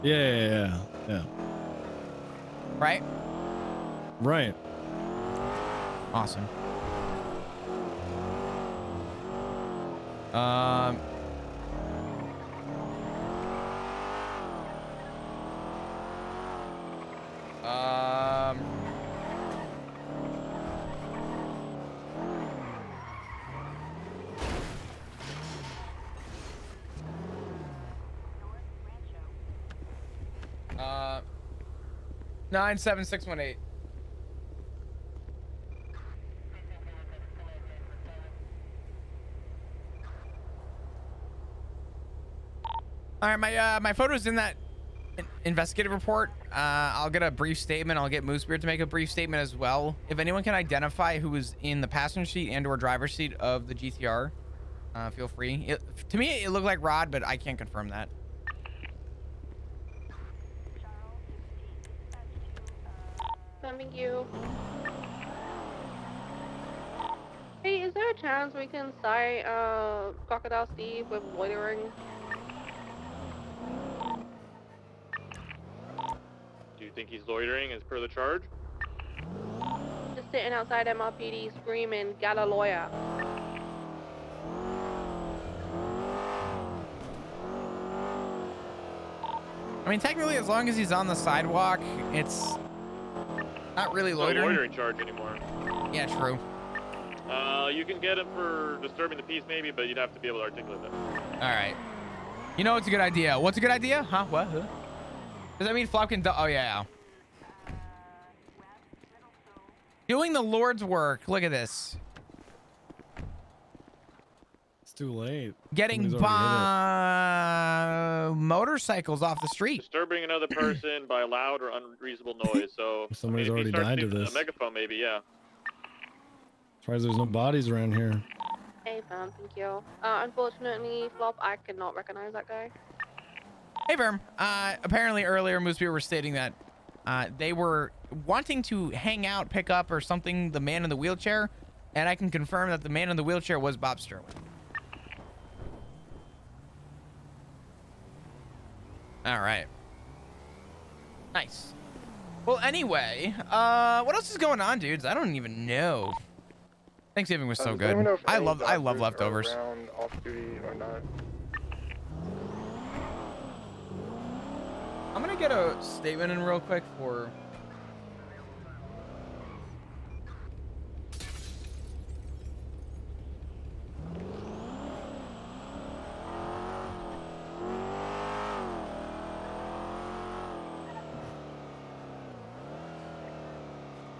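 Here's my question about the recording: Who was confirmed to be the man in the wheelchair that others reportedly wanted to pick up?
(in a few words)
Bob Sterling.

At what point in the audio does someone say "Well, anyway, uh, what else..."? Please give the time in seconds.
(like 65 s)
152 s.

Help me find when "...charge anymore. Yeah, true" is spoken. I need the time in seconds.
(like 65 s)
94 s.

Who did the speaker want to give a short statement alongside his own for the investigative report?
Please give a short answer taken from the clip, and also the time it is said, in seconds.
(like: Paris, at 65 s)
Moosebeard, at 48 s.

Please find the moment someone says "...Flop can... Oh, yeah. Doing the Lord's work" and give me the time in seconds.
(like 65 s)
105 s.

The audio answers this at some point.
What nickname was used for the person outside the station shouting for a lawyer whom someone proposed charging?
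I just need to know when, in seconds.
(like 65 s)
70 s.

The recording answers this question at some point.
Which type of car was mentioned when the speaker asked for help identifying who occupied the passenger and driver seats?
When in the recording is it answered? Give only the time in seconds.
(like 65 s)
53 s.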